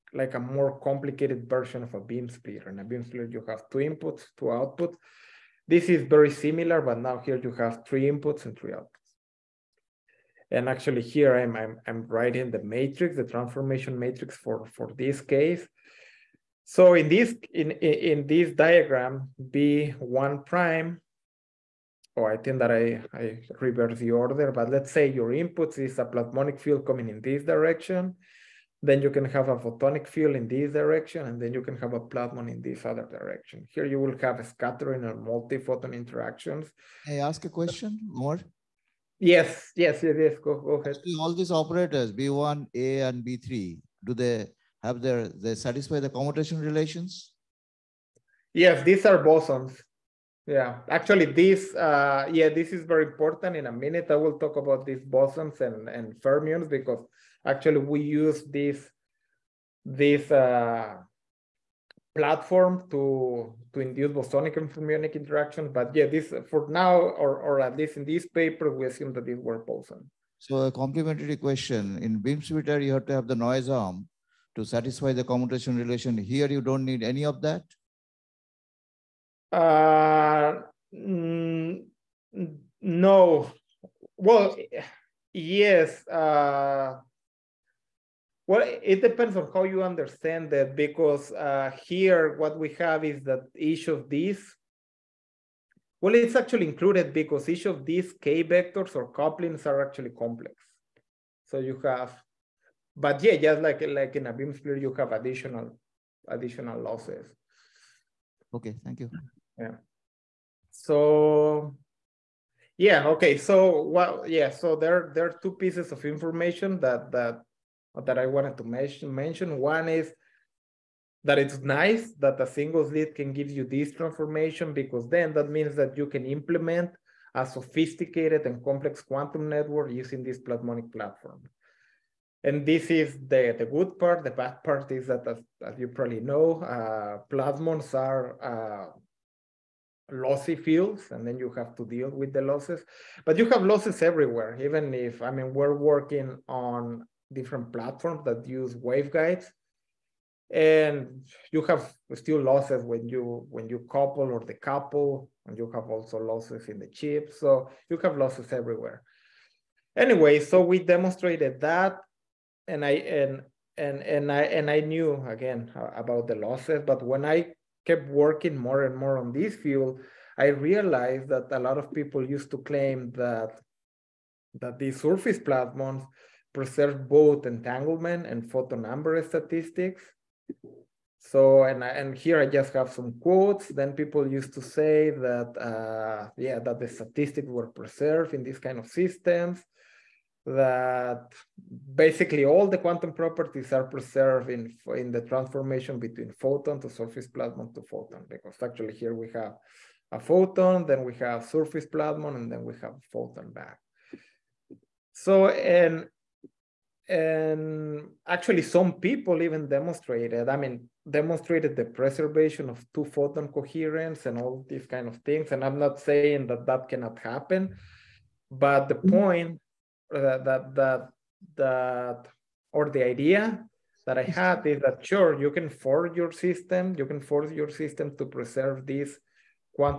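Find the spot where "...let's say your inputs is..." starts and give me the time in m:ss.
0:24.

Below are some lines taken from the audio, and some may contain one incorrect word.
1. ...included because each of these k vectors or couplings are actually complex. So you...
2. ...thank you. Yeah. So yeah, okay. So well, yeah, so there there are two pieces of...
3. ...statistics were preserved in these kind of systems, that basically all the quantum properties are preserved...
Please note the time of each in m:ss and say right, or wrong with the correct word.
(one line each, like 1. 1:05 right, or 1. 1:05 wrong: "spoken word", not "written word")
1. 1:36 right
2. 1:48 right
3. 3:06 right.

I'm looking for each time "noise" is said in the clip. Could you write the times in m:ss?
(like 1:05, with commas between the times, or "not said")
1:13.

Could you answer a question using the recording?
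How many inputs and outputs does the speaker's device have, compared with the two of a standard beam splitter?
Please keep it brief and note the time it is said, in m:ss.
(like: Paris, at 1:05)
3, at 0:07.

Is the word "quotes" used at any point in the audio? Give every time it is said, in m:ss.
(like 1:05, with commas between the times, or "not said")
3:03.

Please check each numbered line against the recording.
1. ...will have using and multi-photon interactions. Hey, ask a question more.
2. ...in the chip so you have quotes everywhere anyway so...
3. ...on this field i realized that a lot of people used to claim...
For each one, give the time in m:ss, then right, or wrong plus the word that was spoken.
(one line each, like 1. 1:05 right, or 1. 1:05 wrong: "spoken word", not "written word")
1. 0:33 wrong: "scattering", not "using"
2. 2:36 wrong: "losses", not "quotes"
3. 2:49 right.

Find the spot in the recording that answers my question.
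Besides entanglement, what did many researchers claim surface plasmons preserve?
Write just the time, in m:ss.
2:58.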